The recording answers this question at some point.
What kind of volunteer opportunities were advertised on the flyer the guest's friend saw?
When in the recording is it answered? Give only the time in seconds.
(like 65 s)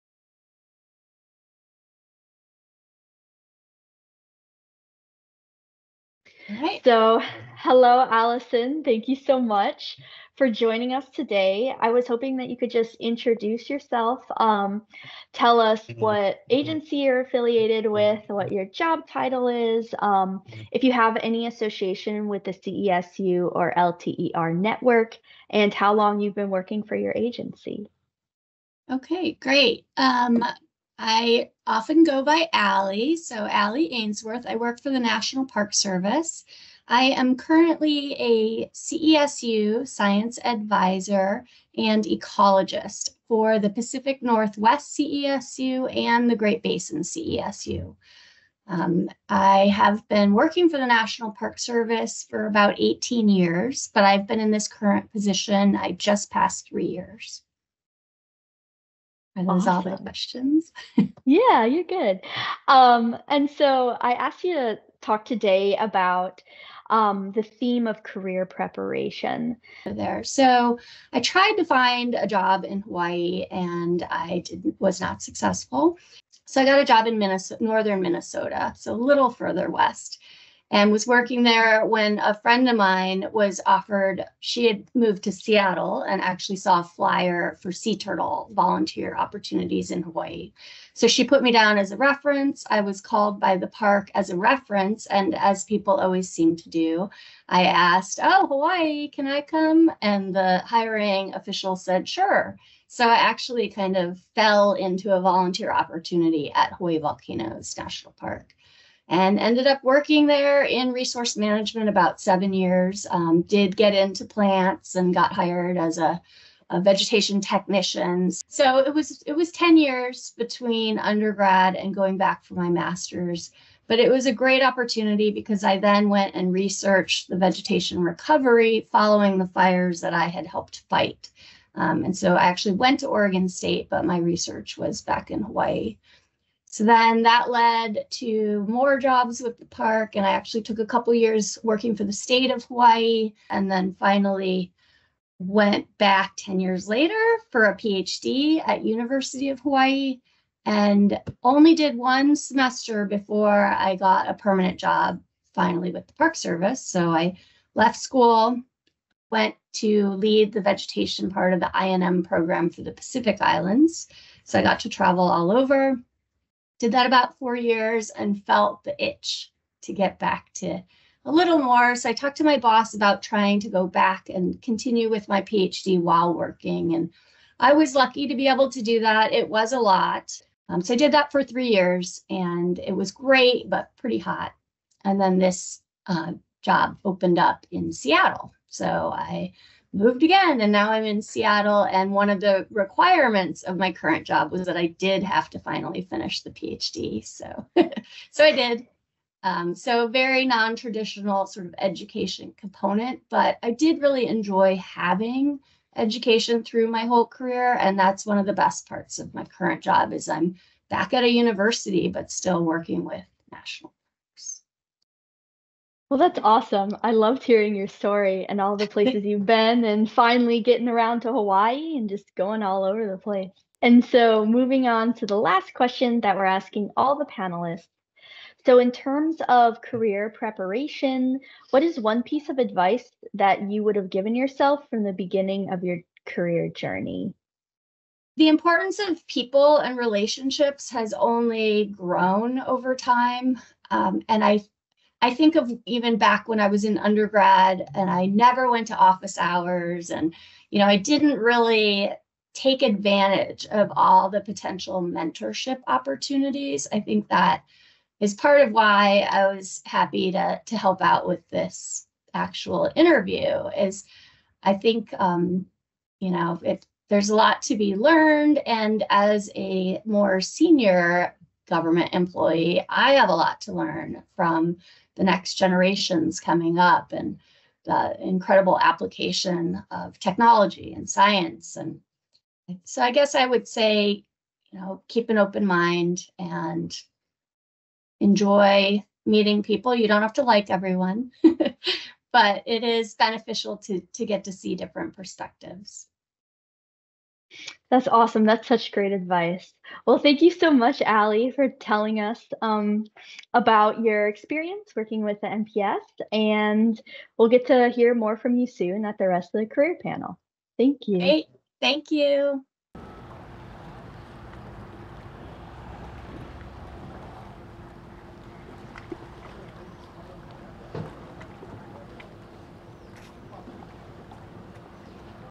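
87 s.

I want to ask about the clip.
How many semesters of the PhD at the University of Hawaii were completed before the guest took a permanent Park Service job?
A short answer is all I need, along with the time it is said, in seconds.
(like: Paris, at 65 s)
1, at 151 s.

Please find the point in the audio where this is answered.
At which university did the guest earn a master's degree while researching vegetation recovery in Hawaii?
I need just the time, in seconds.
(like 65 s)
133 s.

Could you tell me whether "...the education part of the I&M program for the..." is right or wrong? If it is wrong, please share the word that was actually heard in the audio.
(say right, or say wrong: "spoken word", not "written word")
wrong: "vegetation", not "education".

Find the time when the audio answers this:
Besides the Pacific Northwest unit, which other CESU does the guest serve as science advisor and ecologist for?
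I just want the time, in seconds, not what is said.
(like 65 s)
46 s.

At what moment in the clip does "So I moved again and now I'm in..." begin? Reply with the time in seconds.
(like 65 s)
188 s.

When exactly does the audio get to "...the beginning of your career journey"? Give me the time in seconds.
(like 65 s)
235 s.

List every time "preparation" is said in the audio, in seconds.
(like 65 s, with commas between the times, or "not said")
68 s, 230 s.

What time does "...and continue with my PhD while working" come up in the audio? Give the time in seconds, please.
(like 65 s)
174 s.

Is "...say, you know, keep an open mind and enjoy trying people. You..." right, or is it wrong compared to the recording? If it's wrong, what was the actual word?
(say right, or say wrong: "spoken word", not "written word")
wrong: "meeting", not "trying".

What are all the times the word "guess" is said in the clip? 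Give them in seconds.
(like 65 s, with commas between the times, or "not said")
283 s.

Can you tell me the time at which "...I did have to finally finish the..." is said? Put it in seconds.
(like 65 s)
194 s.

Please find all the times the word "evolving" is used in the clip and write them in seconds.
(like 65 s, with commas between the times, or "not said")
not said.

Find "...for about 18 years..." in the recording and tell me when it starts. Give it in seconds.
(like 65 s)
52 s.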